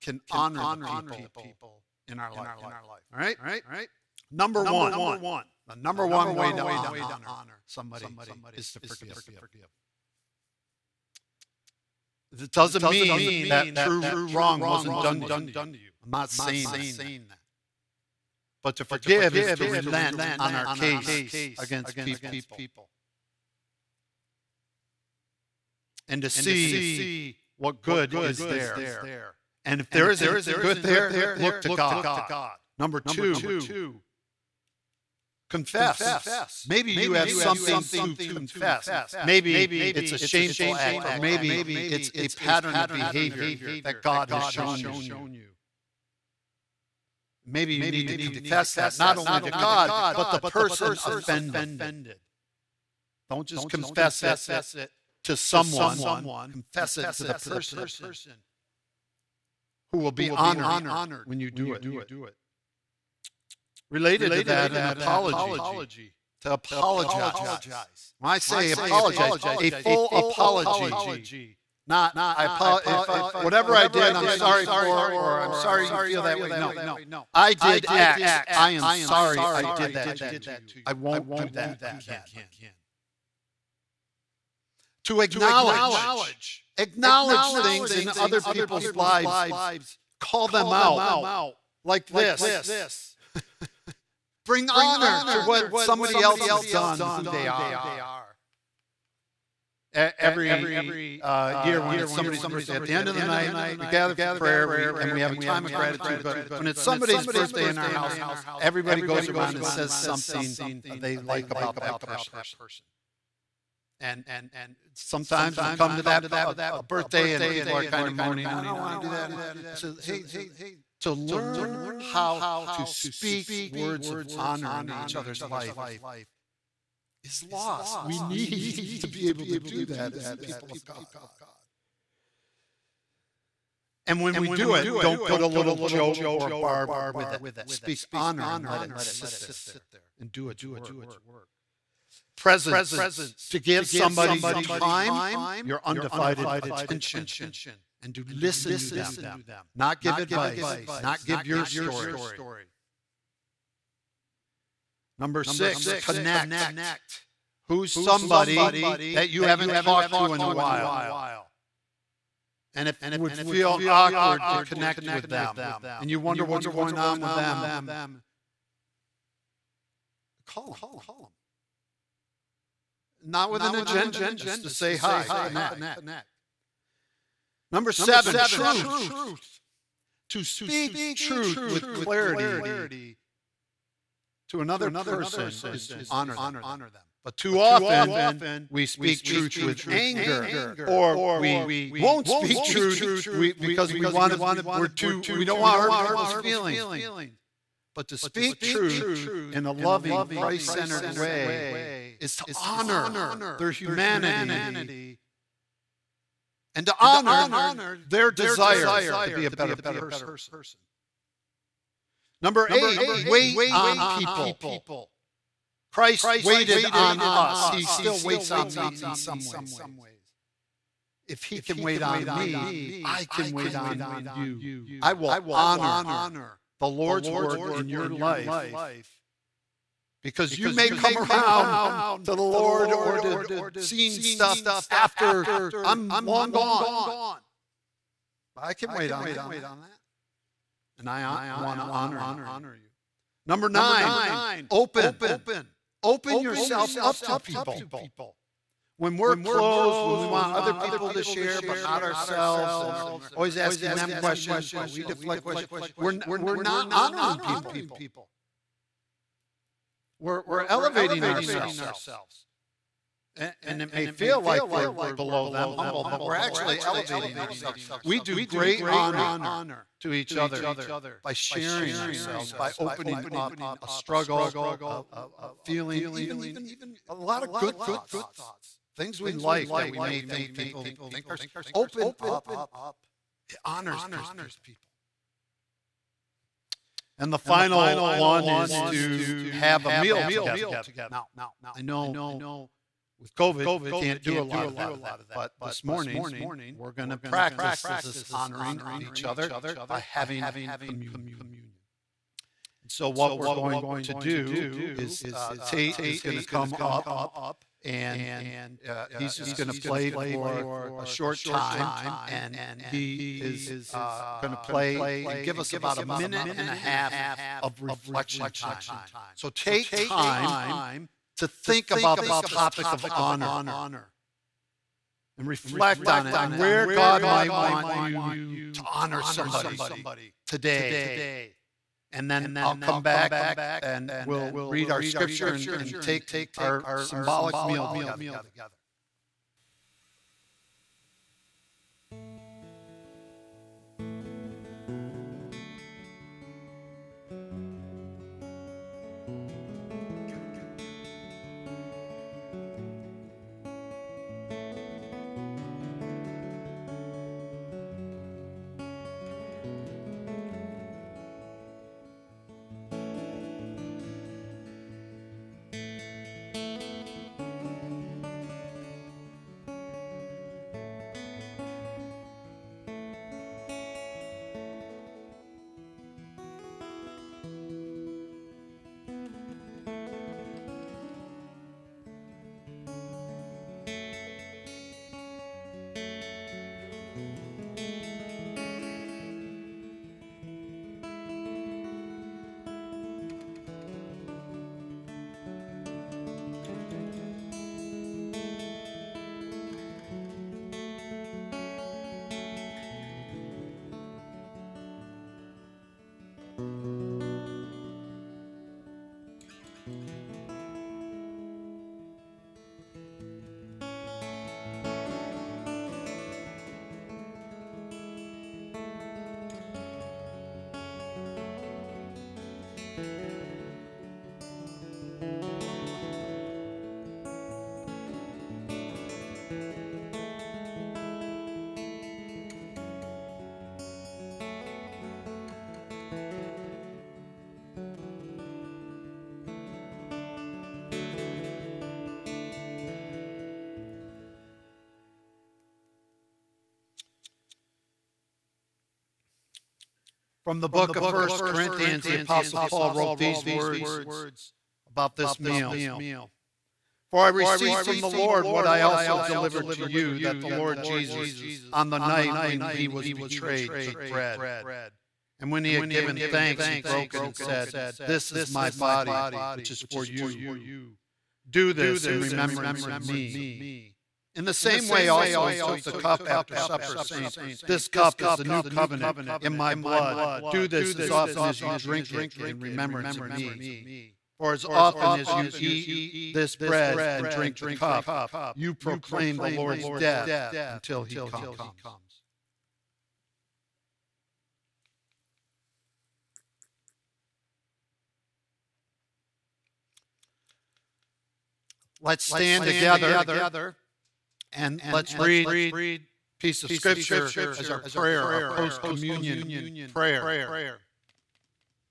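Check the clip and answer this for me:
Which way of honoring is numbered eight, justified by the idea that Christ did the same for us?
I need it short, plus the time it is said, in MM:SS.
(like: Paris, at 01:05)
Wait on people, at 03:33.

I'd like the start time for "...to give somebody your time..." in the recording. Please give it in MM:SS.
02:23.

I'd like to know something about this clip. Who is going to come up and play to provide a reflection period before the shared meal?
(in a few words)
Tate.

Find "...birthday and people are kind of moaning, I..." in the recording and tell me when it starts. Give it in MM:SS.
01:56.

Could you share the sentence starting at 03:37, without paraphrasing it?
He still waits on me in some ways.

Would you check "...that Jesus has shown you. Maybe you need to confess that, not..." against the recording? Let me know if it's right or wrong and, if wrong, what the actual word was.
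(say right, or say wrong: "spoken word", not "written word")
wrong: "God", not "Jesus".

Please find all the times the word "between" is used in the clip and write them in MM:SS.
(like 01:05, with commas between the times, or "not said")
not said.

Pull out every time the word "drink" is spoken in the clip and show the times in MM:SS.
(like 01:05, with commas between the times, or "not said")
08:01, 08:07.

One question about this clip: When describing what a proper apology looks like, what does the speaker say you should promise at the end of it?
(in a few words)
I won't do that again.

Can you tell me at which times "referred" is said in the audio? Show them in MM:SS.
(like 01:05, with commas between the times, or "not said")
not said.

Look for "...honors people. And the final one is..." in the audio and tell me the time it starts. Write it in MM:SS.
04:43.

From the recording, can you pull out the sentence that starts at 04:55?
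But this morning, we're going to practice this honoring of each other by having communion.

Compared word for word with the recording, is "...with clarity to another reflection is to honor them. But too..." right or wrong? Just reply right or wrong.
wrong.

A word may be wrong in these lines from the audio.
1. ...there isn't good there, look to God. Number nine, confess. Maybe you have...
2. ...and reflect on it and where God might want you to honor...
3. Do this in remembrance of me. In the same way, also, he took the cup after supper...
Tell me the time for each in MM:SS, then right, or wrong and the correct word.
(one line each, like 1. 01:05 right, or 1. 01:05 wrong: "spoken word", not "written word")
1. 00:29 wrong: "two", not "nine"
2. 05:25 right
3. 07:51 right.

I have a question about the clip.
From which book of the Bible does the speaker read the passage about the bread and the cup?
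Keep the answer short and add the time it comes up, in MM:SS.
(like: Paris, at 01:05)
First Corinthians, at 07:31.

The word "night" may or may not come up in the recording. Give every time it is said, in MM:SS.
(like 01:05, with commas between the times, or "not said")
01:43, 07:41.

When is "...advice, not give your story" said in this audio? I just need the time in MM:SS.
02:30.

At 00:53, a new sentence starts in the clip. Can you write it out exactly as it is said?
Don't just confess it to someone, confess it to the person who will be honored when you do it.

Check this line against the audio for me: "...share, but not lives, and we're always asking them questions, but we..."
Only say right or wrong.
wrong.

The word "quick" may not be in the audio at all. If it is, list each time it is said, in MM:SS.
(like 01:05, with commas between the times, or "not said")
not said.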